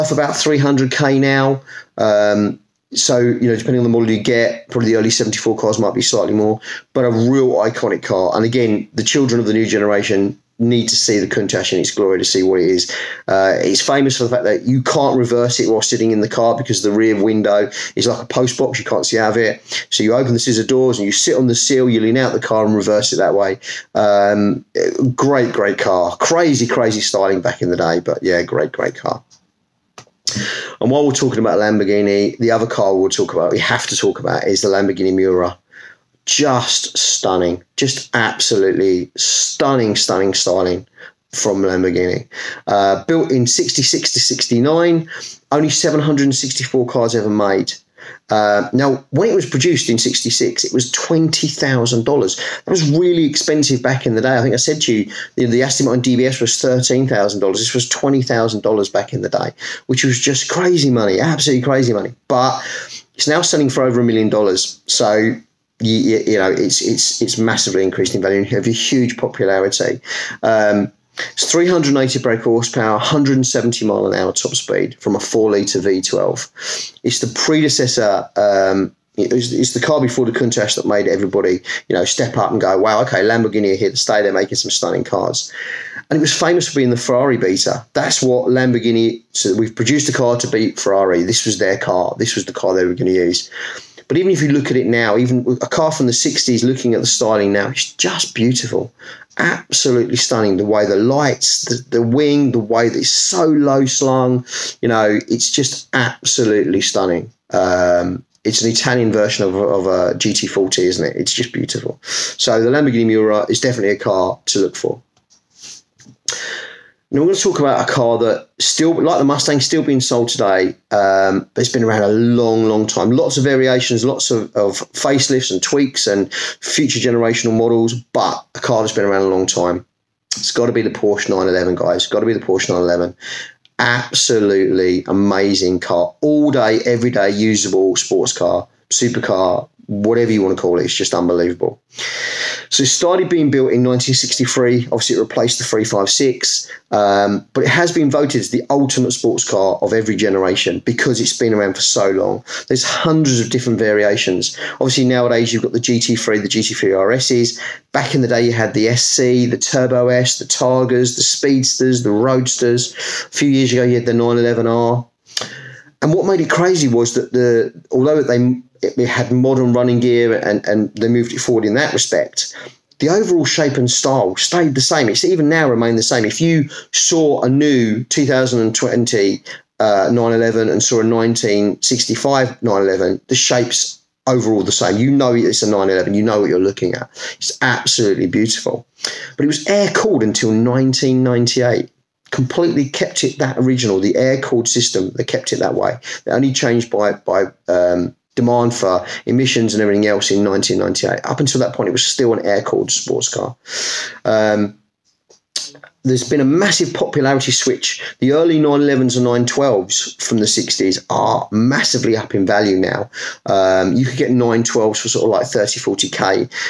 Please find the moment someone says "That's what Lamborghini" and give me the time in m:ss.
1:27.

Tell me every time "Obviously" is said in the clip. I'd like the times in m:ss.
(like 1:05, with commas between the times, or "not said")
2:24, 2:34.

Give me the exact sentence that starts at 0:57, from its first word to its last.
This was $20,000 back in the day, which was just crazy money, absolutely crazy money.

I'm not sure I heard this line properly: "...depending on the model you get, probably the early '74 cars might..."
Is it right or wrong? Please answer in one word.
right.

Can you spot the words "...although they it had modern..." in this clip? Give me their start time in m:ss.
2:47.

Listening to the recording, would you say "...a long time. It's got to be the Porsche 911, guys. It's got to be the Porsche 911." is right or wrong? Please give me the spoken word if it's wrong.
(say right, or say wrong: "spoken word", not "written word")
right.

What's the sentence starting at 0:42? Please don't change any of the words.
Uh, built in 66 to 69, only 764 cars ever made.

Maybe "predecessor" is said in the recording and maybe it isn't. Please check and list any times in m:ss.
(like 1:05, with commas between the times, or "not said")
1:17.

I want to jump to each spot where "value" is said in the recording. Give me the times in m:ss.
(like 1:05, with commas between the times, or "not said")
1:08, 3:32.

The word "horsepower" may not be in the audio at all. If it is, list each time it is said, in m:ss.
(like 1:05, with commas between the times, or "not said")
1:12.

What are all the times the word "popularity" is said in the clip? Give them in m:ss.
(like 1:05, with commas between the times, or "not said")
1:09, 3:26.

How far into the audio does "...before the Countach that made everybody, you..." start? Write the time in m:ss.
1:19.